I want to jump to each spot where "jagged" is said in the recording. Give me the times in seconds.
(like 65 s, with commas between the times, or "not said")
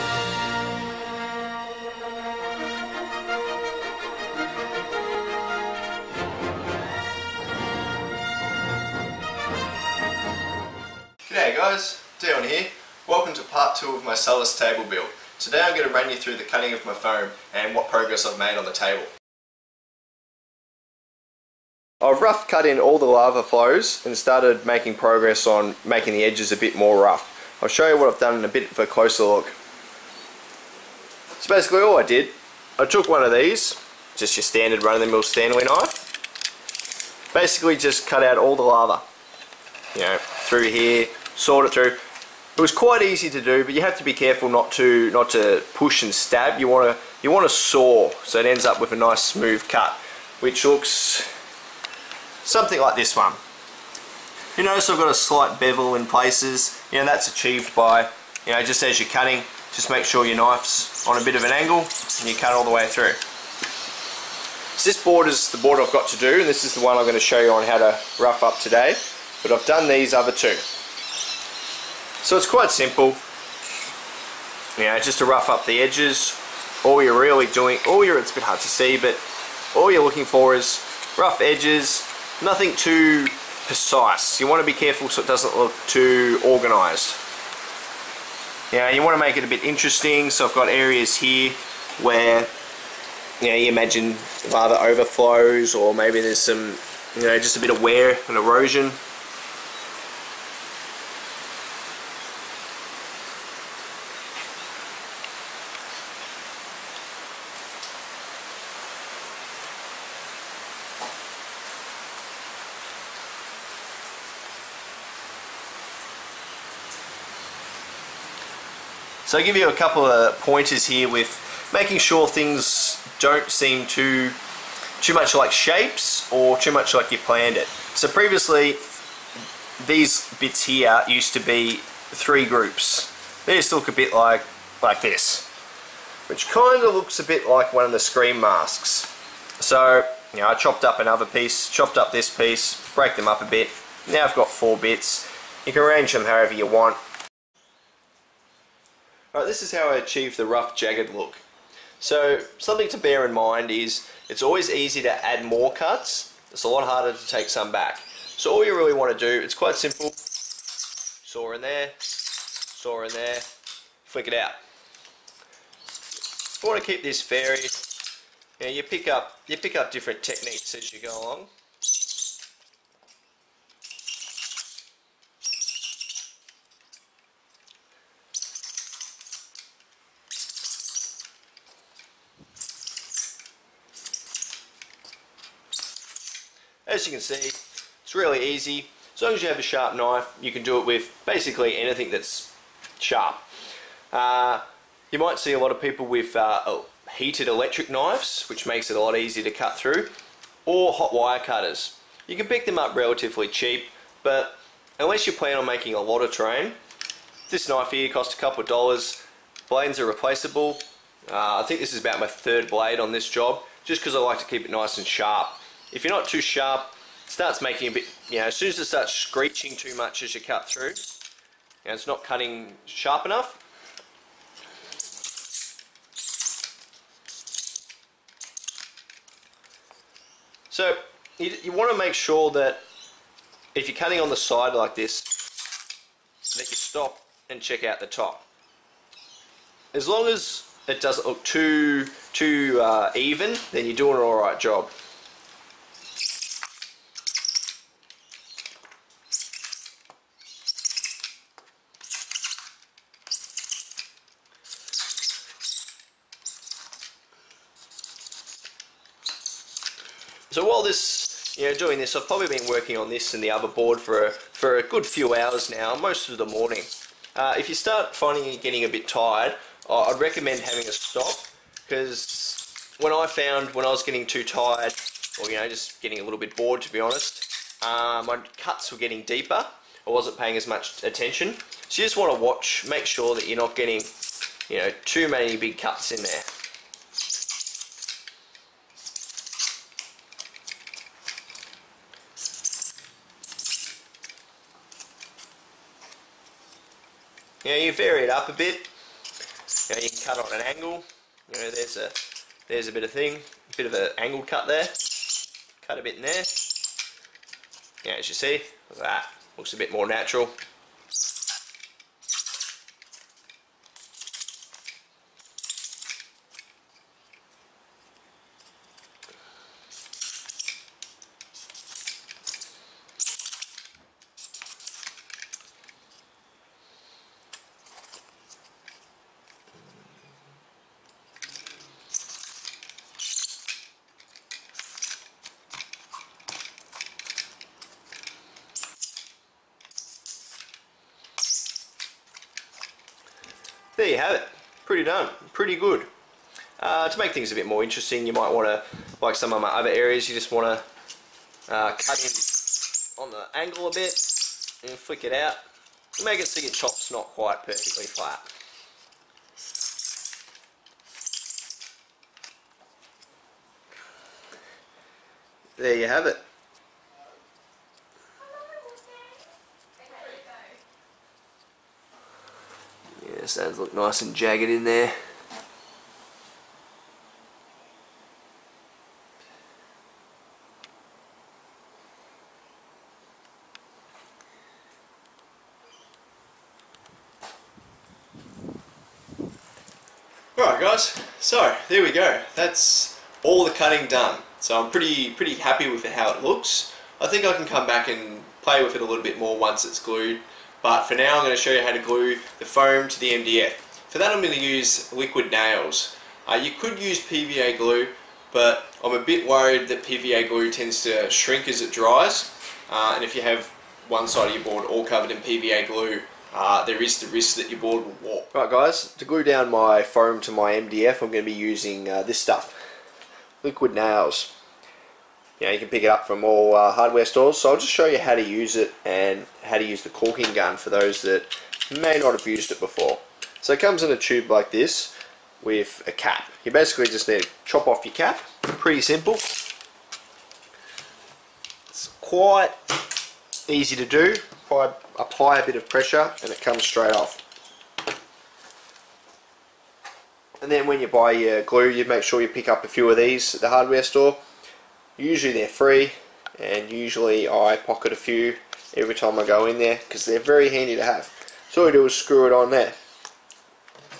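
150 s, 374 s.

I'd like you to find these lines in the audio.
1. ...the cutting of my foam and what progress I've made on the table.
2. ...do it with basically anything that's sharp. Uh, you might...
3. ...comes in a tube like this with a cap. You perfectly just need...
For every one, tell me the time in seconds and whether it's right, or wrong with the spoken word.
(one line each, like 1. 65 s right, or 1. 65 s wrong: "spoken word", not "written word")
1. 16 s right
2. 190 s right
3. 433 s wrong: "basically", not "perfectly".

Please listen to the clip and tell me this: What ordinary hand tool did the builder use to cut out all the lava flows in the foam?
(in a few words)
Stanley knife.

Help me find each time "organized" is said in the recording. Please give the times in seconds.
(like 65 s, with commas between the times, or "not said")
86 s.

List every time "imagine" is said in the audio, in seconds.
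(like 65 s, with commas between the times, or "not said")
93 s.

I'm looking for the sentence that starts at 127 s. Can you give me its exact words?
So previously these bits here used to be three groups.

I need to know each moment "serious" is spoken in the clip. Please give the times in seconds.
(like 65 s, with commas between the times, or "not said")
not said.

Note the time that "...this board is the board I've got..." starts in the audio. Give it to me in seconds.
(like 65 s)
64 s.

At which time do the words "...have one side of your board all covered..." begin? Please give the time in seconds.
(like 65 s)
413 s.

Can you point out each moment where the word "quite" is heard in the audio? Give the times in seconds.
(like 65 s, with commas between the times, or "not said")
42 s, 72 s, 159 s, 357 s, 442 s.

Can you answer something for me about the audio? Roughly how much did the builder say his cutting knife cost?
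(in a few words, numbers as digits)
a couple of dollars.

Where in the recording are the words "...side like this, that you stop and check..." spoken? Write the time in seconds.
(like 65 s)
234 s.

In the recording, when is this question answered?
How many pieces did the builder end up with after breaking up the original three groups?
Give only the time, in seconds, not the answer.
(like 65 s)
144 s.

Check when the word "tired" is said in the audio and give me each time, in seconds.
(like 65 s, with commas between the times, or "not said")
269 s, 274 s.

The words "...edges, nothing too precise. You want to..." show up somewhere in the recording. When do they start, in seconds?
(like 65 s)
81 s.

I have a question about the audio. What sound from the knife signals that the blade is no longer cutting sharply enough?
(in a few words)
screeching.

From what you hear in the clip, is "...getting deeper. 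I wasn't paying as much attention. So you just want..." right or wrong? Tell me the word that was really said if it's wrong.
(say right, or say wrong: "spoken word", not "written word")
right.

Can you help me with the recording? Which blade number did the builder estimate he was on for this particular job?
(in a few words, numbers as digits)
third.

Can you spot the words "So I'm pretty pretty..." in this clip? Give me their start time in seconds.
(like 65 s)
394 s.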